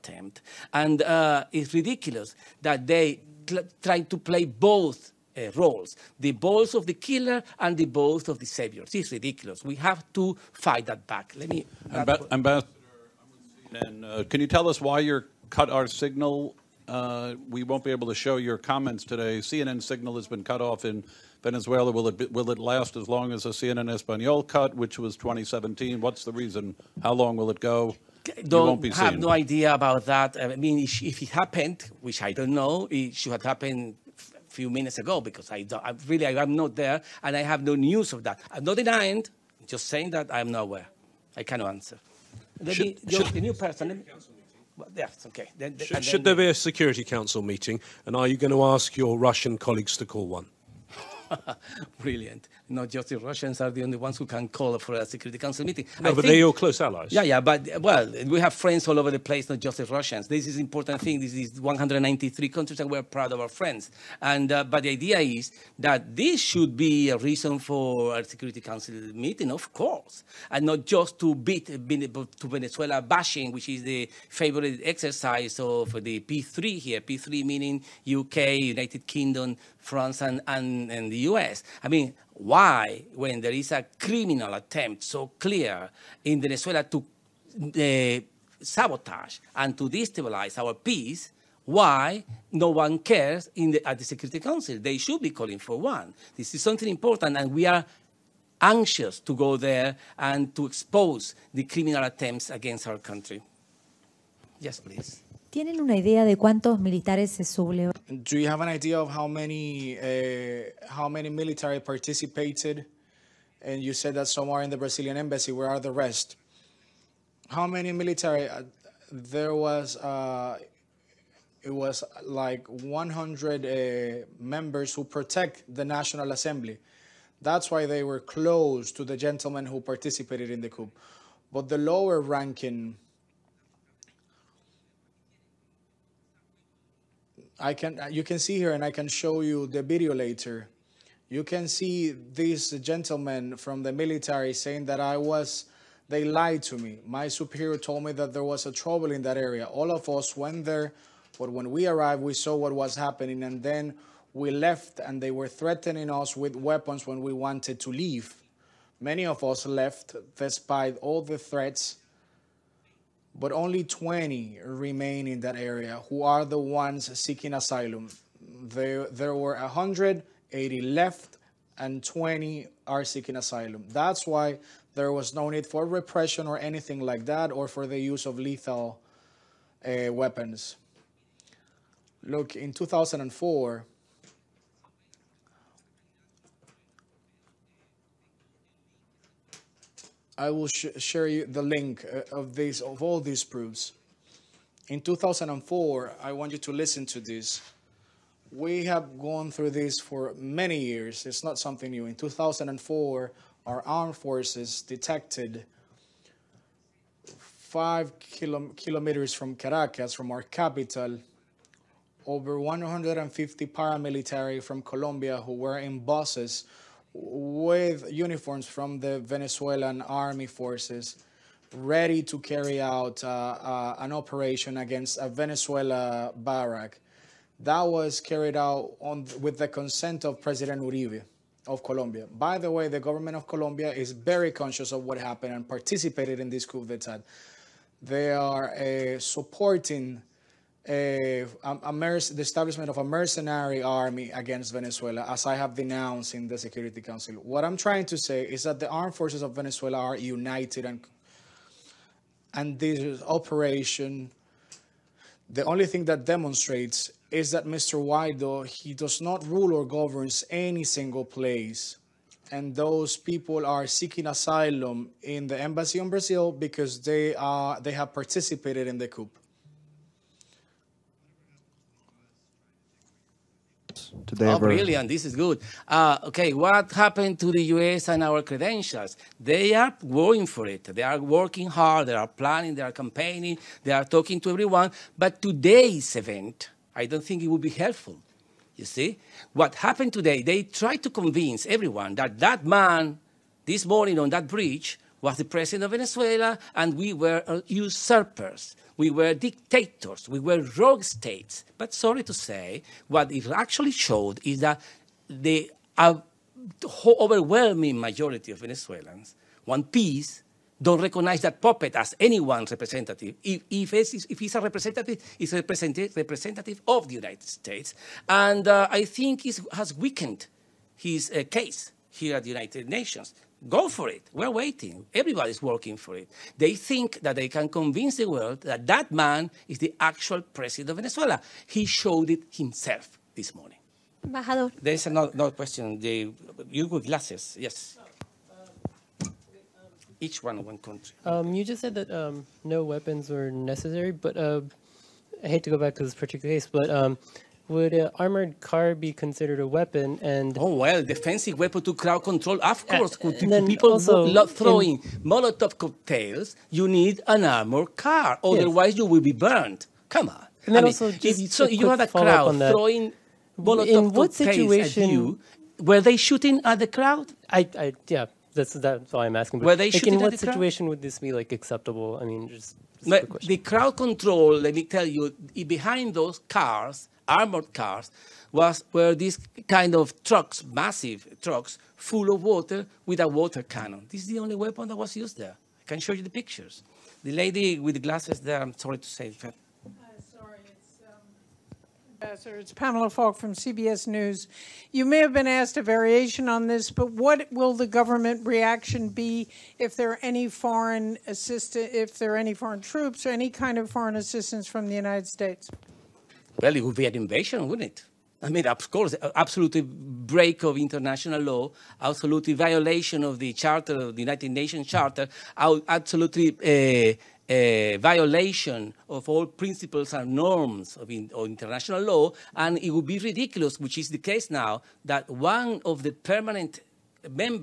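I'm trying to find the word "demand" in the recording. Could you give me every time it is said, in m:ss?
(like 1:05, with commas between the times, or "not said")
not said.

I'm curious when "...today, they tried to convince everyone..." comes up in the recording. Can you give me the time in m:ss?
4:50.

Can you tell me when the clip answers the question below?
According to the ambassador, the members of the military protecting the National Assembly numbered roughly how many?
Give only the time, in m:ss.
2:02.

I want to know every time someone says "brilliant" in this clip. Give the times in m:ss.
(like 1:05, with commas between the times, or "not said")
0:52, 4:34.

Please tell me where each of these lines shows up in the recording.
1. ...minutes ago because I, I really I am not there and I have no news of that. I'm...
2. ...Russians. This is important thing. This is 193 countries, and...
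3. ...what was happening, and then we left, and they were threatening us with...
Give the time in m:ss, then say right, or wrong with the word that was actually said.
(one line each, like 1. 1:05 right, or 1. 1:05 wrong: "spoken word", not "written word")
1. 0:34 right
2. 0:59 right
3. 2:32 right.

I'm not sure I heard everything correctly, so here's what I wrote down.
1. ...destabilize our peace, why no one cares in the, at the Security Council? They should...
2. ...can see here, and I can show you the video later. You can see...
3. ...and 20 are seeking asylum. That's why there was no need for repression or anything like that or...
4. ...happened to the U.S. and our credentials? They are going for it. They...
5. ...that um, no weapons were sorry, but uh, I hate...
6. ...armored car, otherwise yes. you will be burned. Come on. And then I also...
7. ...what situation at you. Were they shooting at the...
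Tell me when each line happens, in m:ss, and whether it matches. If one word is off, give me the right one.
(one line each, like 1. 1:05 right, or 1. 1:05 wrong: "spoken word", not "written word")
1. 1:29 right
2. 2:18 right
3. 2:51 right
4. 4:36 right
5. 5:41 wrong: "necessary", not "sorry"
6. 5:57 right
7. 6:04 right.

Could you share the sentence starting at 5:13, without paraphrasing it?
If, if, it's, if he's a representative, he's a representative, representative of the United States.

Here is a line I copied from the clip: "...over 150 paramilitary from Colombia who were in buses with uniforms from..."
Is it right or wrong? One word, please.
right.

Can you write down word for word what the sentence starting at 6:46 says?
Well, it would be an invasion, wouldn't it?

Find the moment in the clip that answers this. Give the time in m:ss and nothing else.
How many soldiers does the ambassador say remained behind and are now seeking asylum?
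2:43.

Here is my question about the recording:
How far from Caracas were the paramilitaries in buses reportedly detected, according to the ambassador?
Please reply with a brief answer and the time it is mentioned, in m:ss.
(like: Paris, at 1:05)
5 kilometers, at 3:27.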